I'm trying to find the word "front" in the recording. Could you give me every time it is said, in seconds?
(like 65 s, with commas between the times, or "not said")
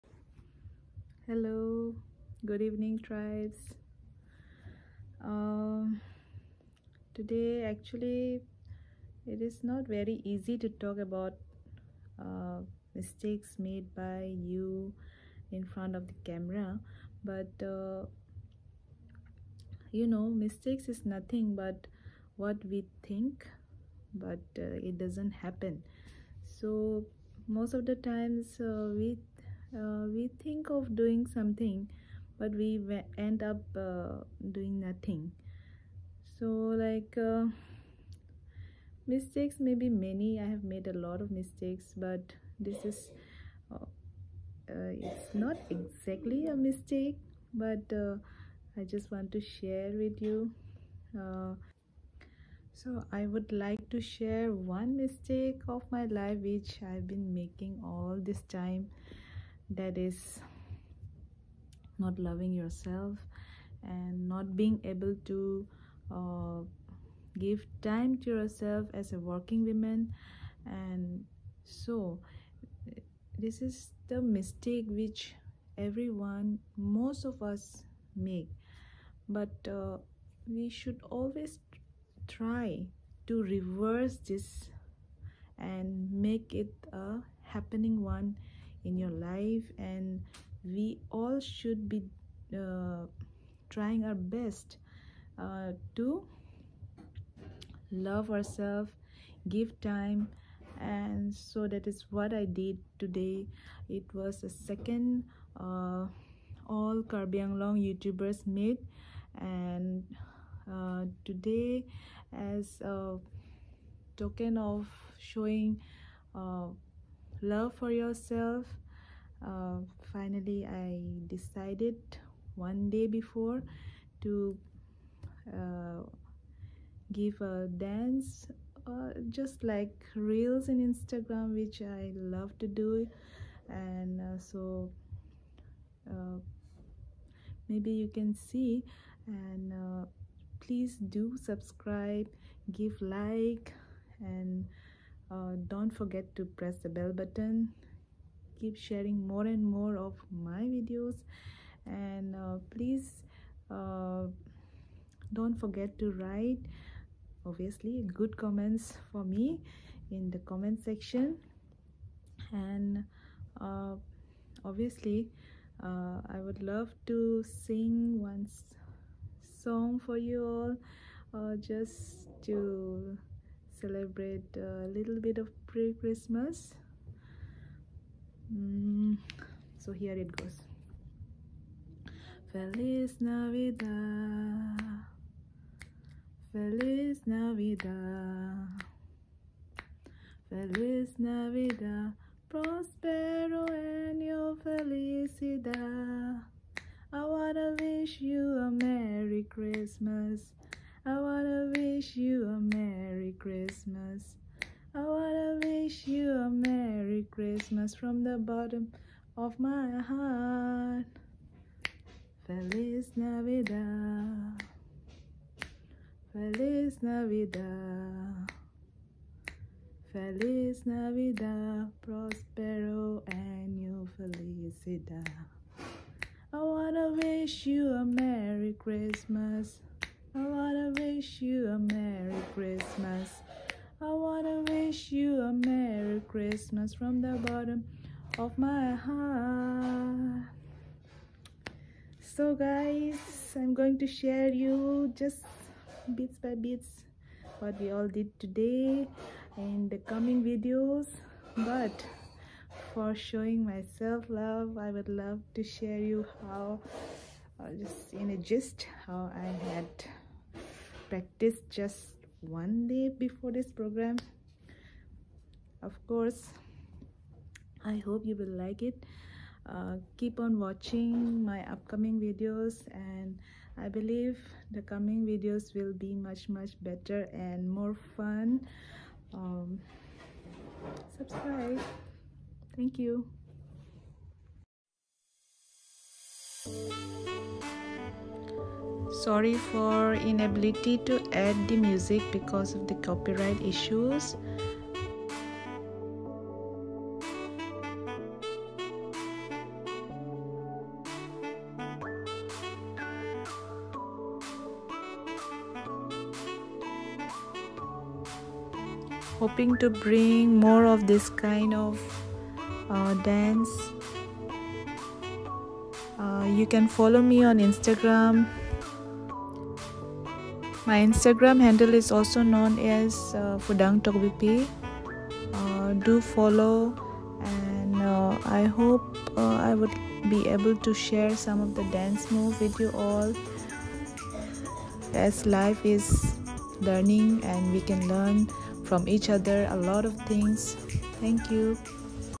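15 s.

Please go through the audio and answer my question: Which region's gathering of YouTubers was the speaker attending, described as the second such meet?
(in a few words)
Karbi Anglong.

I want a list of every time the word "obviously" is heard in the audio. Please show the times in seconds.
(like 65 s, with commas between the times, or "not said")
157 s, 164 s.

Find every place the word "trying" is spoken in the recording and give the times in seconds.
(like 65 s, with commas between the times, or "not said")
93 s.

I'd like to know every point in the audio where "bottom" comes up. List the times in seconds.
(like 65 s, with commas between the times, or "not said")
208 s, 237 s.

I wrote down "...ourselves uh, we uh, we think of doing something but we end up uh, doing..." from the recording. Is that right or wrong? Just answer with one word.
wrong.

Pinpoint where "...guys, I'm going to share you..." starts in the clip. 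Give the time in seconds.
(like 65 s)
242 s.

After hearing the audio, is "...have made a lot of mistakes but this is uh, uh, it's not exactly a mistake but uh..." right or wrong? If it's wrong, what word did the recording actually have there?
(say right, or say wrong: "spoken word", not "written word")
right.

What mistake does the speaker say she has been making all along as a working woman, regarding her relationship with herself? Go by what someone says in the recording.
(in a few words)
Not loving yourself.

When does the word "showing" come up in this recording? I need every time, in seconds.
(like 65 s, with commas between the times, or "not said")
115 s, 253 s.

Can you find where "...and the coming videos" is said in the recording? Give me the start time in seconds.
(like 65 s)
249 s.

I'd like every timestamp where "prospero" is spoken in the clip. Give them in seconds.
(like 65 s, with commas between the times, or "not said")
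192 s, 222 s.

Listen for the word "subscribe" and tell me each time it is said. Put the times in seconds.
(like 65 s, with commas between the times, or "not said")
141 s, 281 s.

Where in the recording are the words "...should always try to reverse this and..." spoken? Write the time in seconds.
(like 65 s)
80 s.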